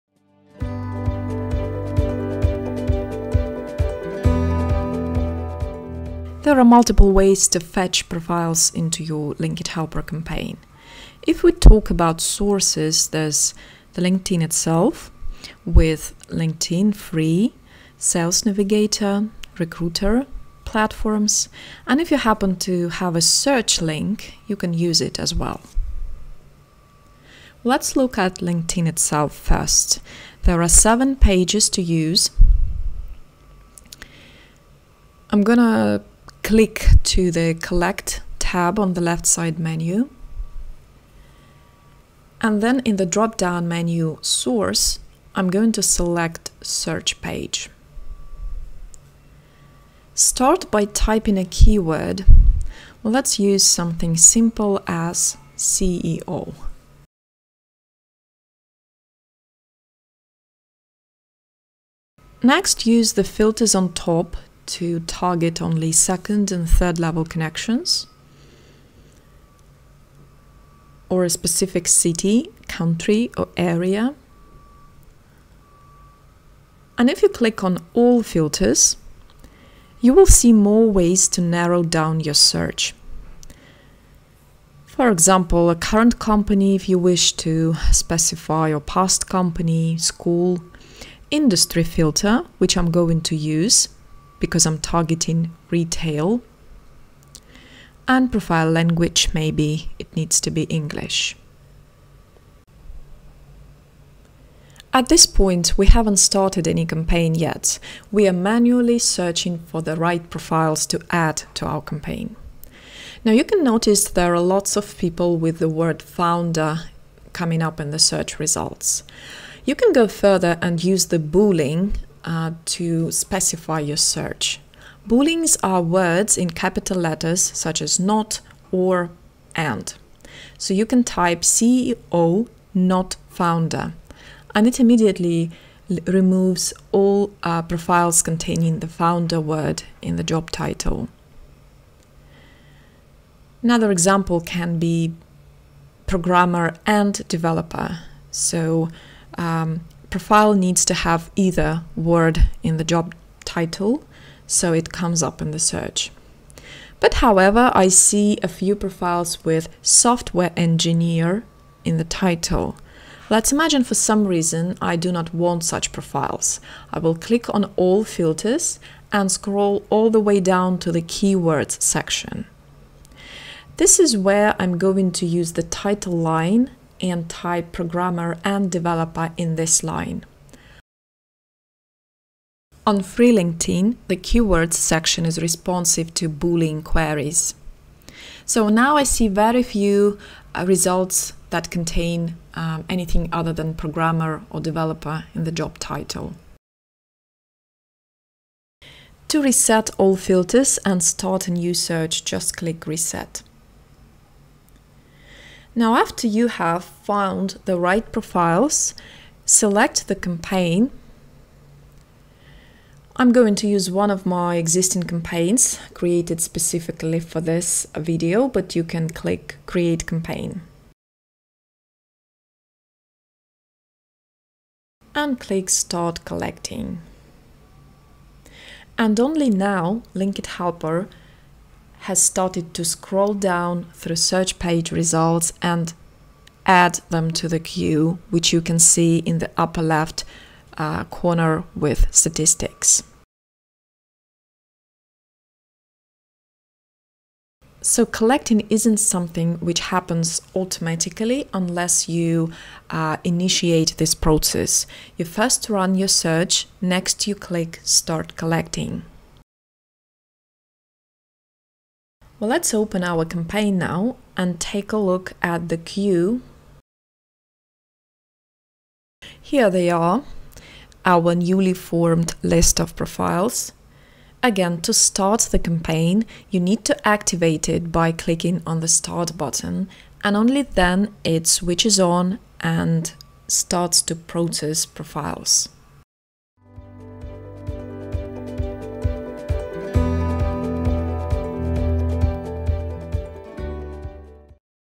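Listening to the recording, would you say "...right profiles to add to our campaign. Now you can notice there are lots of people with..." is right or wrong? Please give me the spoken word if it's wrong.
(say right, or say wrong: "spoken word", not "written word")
right.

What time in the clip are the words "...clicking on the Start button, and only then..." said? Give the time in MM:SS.
04:38.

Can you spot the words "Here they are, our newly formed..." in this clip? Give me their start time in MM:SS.
04:29.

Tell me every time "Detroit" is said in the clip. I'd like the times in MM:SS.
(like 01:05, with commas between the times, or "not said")
not said.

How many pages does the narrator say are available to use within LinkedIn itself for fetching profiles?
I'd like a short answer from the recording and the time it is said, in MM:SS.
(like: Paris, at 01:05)
7, at 00:30.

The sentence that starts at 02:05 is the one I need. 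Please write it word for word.
Booleans are words in capital letters such as not or and.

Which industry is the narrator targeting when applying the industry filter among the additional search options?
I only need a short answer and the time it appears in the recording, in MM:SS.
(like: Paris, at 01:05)
retail, at 01:35.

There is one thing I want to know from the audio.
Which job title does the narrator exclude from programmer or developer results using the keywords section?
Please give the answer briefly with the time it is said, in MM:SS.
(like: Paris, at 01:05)
software engineer, at 02:39.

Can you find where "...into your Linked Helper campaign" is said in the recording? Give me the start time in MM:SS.
00:08.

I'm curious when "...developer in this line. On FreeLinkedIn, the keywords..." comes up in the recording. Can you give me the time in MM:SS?
02:58.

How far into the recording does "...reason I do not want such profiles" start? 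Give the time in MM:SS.
02:44.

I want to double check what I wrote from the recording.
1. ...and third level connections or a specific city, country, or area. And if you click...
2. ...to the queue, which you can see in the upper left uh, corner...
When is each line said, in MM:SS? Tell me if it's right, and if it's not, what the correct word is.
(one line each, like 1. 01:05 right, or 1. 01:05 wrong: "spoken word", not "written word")
1. 01:06 right
2. 03:57 right.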